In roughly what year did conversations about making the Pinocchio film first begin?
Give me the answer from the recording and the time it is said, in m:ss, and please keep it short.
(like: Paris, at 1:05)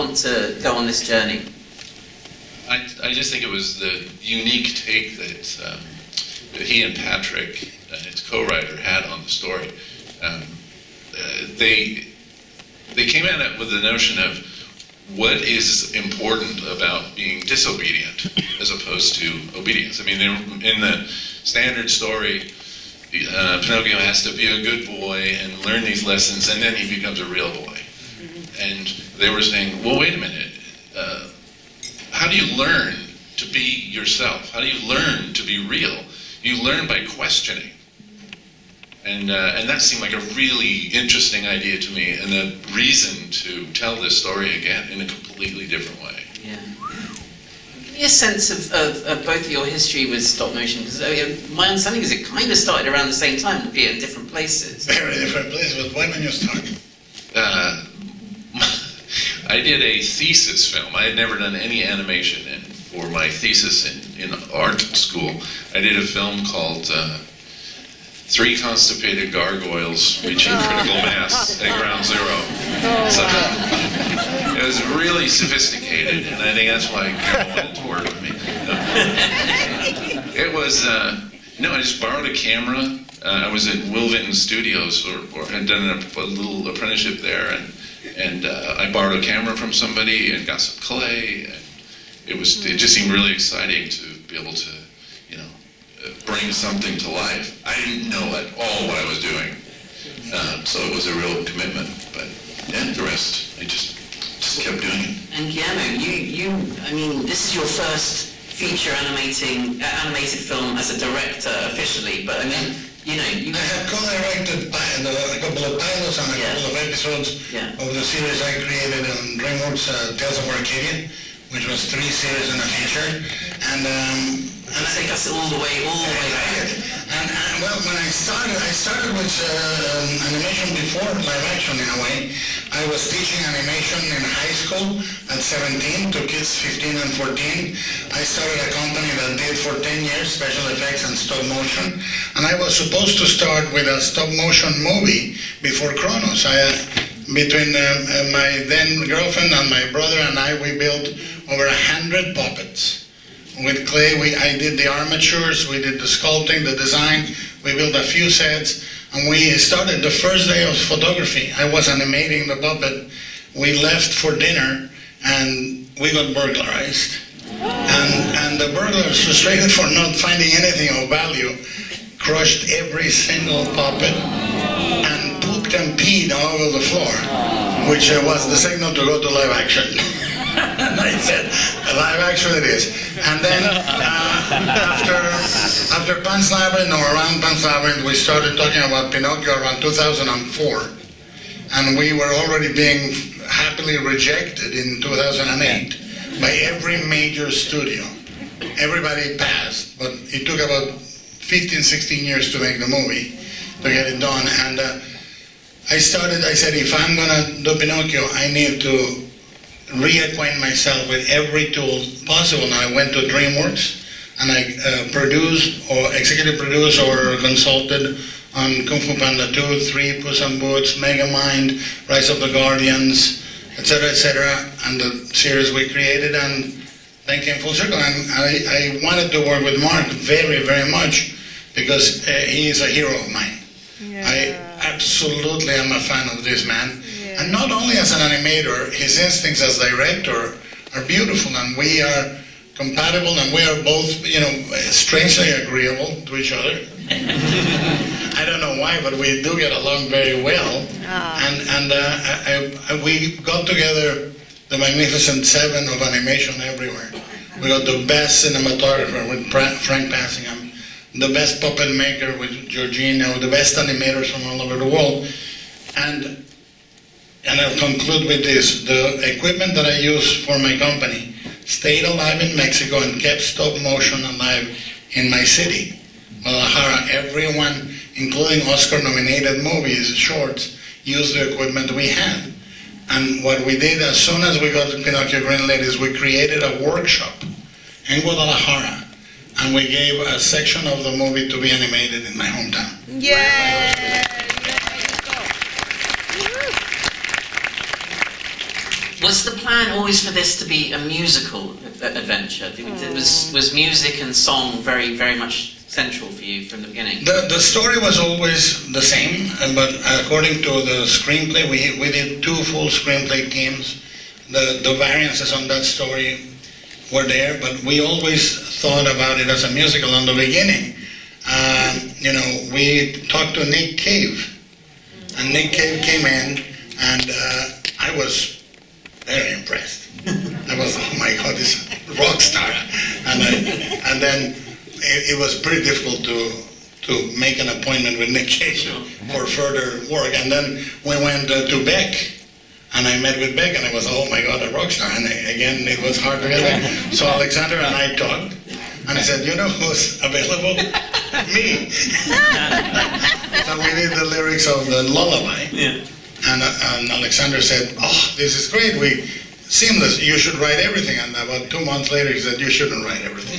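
2004, at 3:09.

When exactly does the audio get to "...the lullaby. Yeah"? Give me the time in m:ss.
5:54.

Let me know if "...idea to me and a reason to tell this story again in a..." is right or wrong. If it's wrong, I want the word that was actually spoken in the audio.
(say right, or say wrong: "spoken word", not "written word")
right.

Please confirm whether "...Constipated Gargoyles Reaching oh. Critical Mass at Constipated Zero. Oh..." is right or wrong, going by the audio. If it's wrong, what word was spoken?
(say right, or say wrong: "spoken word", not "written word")
wrong: "Ground", not "Constipated".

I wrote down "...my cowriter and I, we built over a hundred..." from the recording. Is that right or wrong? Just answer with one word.
wrong.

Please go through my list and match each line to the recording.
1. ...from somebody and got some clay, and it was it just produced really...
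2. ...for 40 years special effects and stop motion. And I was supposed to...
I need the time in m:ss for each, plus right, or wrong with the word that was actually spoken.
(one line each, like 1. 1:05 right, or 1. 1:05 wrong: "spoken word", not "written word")
1. 1:29 wrong: "seemed", not "produced"
2. 2:19 wrong: "10", not "40".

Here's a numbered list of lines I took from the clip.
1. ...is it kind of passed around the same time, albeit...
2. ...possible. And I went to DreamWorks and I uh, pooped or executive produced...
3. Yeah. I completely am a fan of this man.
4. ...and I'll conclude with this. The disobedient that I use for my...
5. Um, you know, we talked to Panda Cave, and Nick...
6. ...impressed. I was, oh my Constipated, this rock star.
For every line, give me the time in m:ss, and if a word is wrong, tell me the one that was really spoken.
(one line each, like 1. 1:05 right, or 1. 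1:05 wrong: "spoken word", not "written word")
1. 0:52 wrong: "started", not "passed"
2. 3:32 wrong: "produced", not "pooped"
3. 3:54 wrong: "absolutely", not "completely"
4. 4:27 wrong: "equipment", not "disobedient"
5. 5:21 wrong: "Nick", not "Panda"
6. 5:29 wrong: "God", not "Constipated".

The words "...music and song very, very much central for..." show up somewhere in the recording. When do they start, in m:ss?
5:03.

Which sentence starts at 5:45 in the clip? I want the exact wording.
And I, again, it was hard to get back.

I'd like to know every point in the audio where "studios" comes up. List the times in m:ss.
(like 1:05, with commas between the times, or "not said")
1:24, 3:17.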